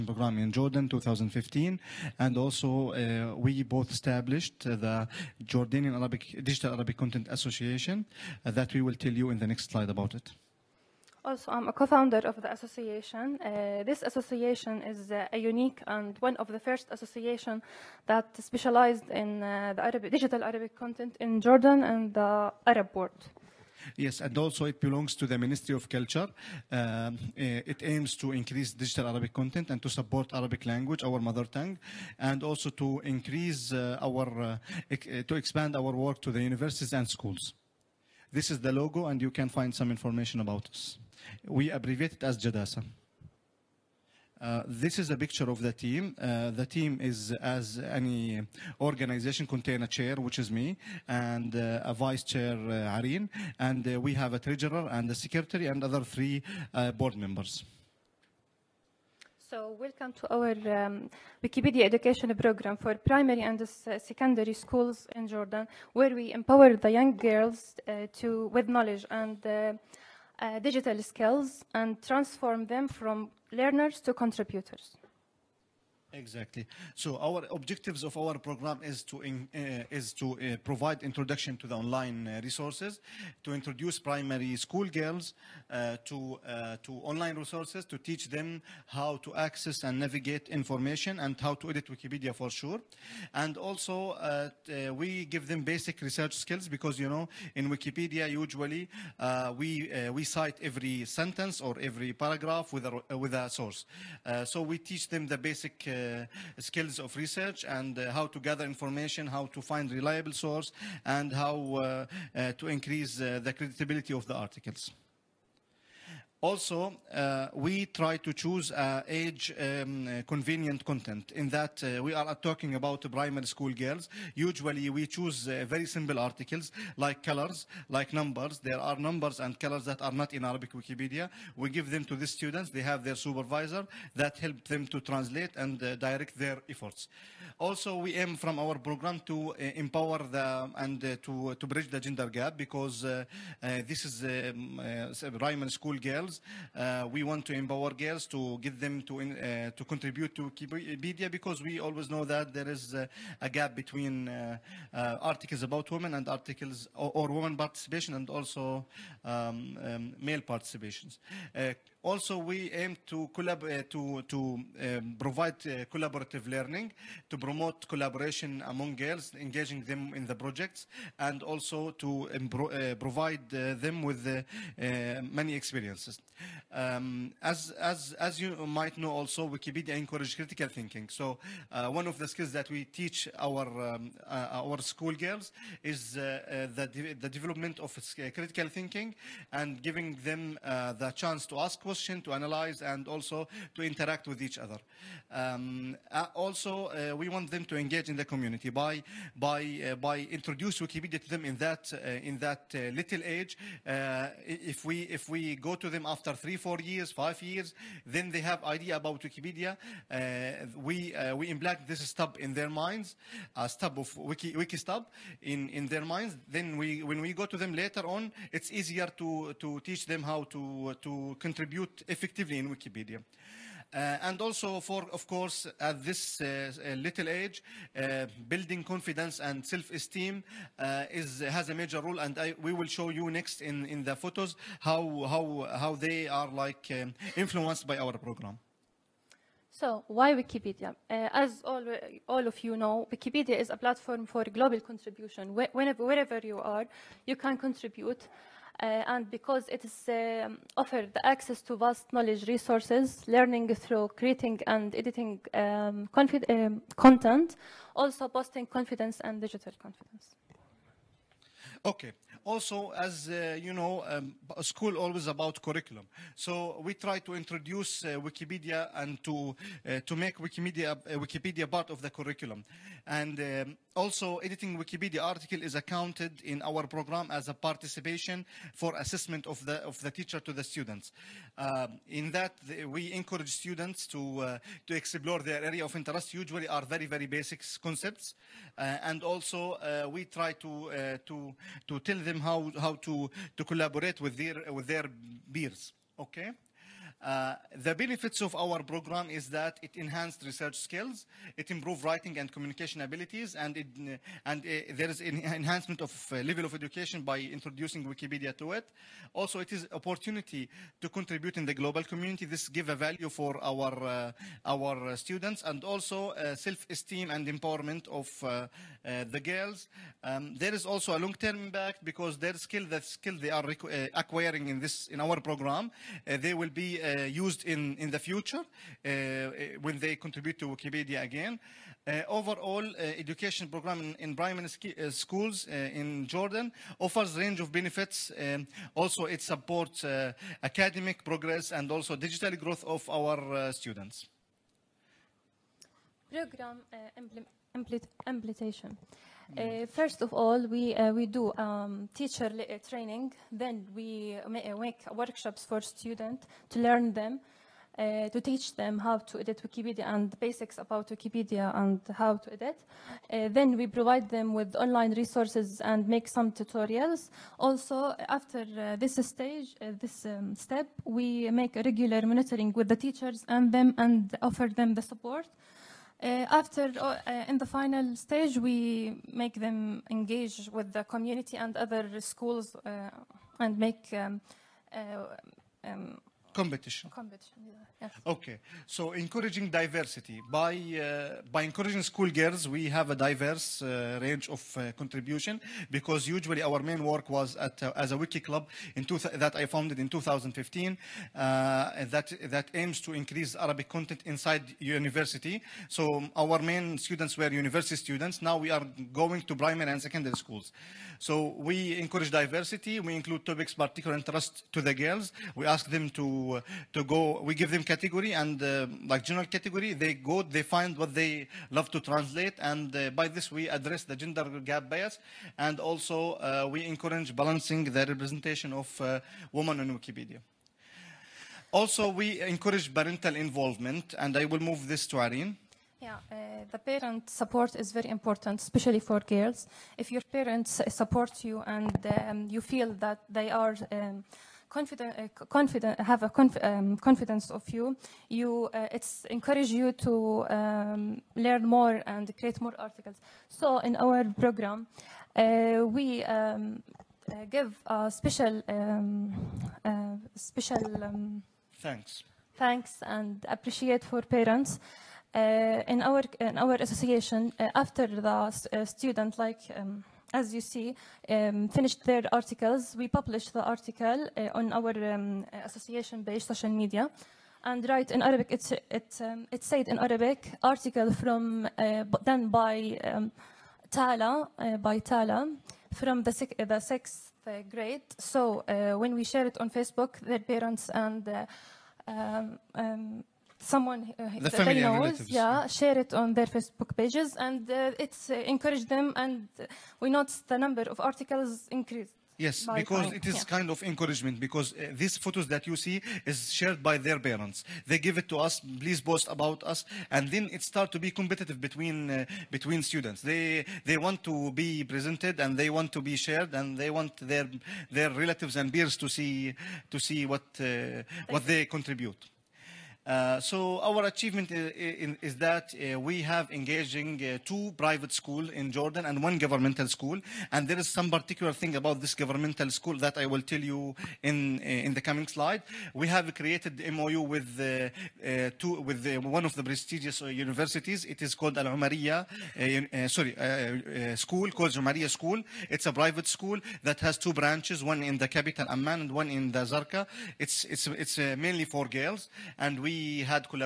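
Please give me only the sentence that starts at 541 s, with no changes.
It is called Al Umariya, sorry, school called Umariya School.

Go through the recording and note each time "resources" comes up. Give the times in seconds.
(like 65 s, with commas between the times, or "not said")
82 s, 87 s, 252 s, 365 s.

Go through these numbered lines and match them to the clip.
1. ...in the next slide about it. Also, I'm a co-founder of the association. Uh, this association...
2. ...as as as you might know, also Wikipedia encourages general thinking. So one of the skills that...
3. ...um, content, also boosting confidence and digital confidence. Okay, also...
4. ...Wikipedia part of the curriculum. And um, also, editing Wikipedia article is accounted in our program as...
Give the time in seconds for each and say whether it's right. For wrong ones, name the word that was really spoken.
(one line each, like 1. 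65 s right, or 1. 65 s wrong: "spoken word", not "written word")
1. 9 s right
2. 177 s wrong: "critical", not "general"
3. 256 s right
4. 271 s right.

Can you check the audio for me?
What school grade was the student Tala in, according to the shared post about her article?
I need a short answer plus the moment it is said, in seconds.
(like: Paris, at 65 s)
Sixth grade, at 486 s.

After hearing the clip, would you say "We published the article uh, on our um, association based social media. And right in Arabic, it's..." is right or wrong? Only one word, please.
right.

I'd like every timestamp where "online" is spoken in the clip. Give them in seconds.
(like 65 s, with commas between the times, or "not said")
81 s, 87 s, 364 s.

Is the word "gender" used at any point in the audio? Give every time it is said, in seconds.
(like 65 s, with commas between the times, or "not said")
142 s, 424 s.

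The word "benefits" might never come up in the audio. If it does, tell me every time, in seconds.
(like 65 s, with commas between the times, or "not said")
297 s, 337 s.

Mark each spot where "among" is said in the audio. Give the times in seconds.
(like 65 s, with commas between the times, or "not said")
168 s.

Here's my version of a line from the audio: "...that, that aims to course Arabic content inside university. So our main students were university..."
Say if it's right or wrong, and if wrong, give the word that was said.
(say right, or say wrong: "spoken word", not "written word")
wrong: "increase", not "course".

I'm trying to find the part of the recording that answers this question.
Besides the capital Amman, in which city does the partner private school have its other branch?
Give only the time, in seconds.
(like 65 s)
549 s.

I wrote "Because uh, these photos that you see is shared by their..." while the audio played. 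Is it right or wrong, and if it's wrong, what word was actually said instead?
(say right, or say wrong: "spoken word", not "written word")
right.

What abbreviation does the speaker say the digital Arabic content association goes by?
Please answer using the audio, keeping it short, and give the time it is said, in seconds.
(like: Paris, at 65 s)
JADASA, at 42 s.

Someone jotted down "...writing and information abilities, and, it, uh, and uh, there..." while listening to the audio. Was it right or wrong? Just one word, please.
wrong.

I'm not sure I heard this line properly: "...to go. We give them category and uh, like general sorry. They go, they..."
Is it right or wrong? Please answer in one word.
wrong.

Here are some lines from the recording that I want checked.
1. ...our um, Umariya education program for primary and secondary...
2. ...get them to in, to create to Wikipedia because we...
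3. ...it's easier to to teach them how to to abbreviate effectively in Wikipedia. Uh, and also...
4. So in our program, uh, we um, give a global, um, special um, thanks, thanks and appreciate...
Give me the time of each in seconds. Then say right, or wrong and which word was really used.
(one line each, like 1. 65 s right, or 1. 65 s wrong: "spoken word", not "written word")
1. 60 s wrong: "Wikipedia", not "Umariya"
2. 148 s wrong: "contribute", not "create"
3. 218 s wrong: "contribute", not "abbreviate"
4. 453 s wrong: "special", not "global".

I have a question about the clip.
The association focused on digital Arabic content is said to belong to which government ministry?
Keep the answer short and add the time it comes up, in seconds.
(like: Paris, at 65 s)
Ministry of Culture, at 25 s.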